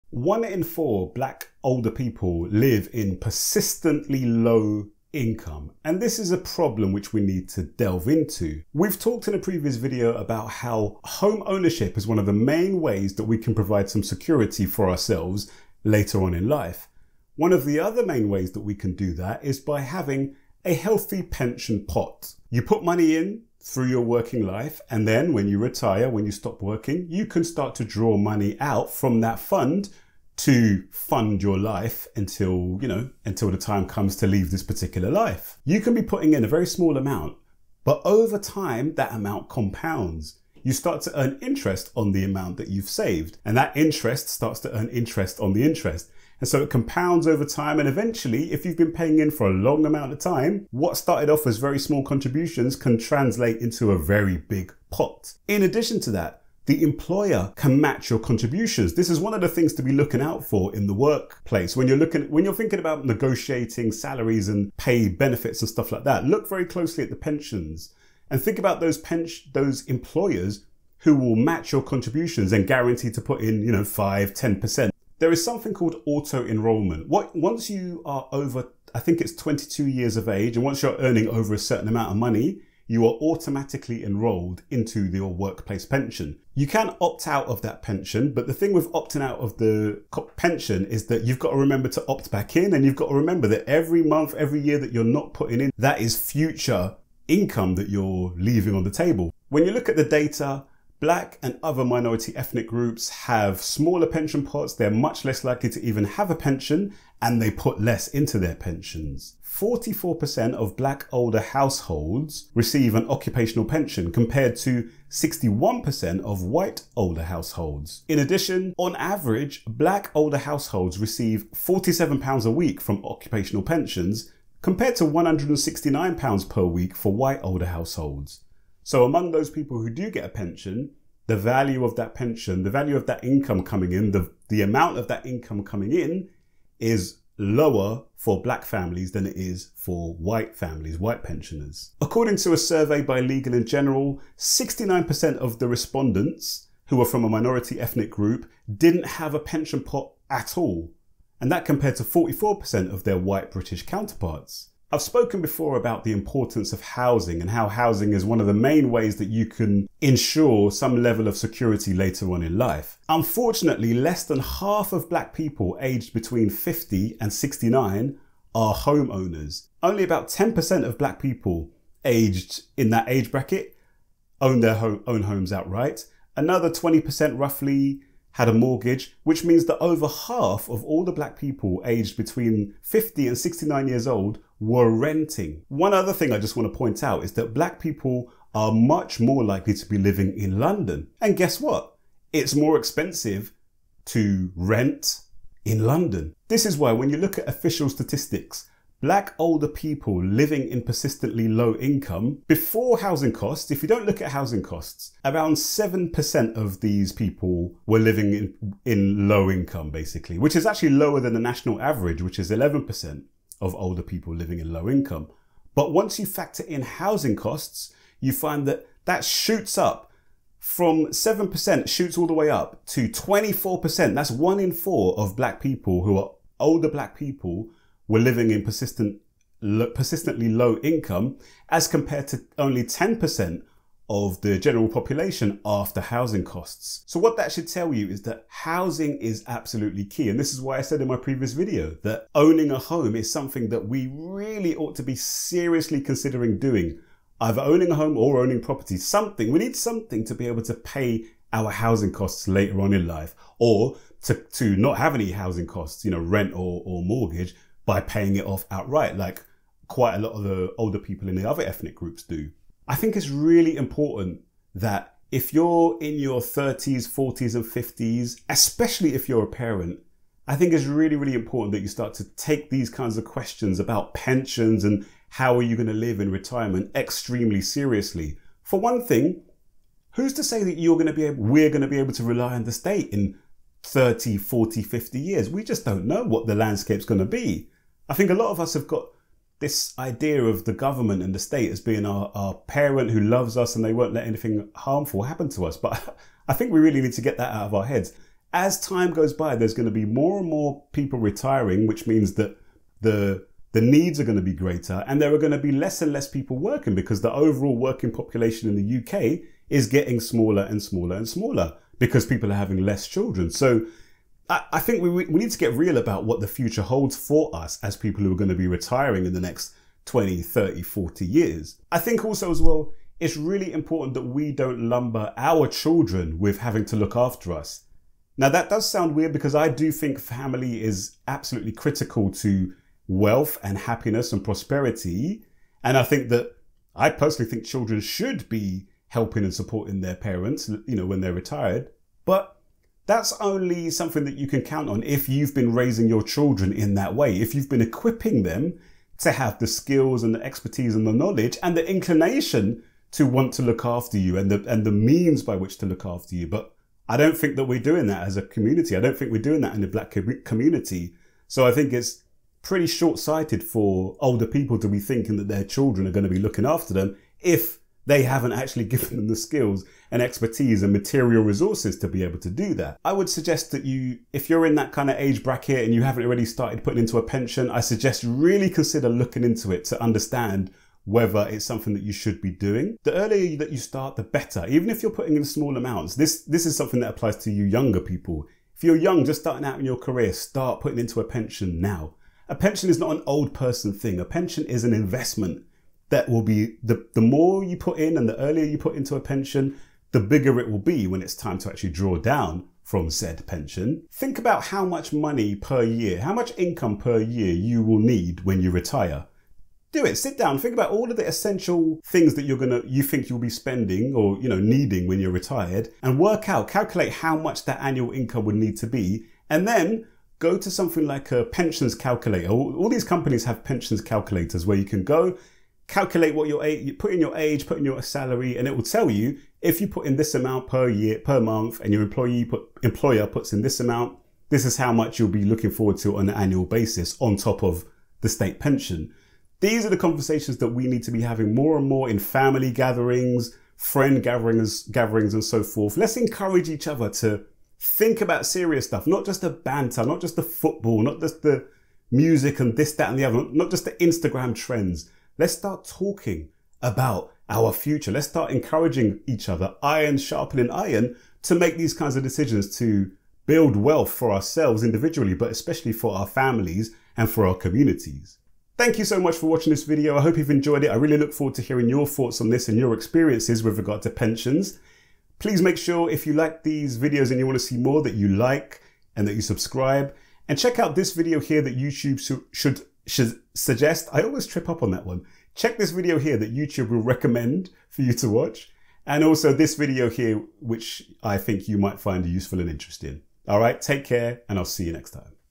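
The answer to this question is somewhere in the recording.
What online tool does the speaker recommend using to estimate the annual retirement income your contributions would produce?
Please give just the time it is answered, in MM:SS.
07:01.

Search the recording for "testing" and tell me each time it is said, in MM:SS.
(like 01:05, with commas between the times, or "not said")
not said.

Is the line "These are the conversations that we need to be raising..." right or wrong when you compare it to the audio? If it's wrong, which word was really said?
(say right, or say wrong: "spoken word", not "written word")
wrong: "having", not "raising".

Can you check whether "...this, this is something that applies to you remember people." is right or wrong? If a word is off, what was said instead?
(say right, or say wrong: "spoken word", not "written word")
wrong: "younger", not "remember".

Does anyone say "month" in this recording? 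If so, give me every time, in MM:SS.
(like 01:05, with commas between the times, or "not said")
01:34, 07:11.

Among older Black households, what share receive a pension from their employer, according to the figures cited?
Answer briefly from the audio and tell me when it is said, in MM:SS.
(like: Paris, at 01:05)
44%, at 01:49.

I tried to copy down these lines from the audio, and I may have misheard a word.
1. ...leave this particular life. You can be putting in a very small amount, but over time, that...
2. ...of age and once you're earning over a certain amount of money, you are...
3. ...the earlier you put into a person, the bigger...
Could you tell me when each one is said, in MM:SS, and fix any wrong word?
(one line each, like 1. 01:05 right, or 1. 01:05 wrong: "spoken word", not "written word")
1. 00:34 right
2. 01:20 right
3. 06:38 wrong: "pension", not "person".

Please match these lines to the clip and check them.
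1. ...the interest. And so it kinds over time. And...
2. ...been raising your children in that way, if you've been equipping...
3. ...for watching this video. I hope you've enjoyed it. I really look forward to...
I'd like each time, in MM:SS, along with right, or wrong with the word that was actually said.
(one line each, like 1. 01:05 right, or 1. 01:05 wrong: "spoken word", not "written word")
1. 00:45 wrong: "compounds", not "kinds"
2. 05:45 right
3. 07:49 right.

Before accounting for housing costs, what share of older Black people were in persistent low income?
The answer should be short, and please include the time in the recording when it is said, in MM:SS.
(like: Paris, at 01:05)
7%, at 03:25.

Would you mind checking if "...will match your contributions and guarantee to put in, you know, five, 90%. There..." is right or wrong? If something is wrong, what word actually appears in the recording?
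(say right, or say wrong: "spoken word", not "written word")
wrong: "10", not "90".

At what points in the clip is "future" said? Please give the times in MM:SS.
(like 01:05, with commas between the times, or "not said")
01:36, 05:16, 07:37.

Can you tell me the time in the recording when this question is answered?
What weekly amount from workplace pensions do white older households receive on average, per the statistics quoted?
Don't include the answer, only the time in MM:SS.
02:05.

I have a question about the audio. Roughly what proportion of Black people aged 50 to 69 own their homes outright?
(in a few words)
10%.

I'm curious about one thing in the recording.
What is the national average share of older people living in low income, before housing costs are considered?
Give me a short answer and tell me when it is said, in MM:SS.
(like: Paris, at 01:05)
11%, at 03:32.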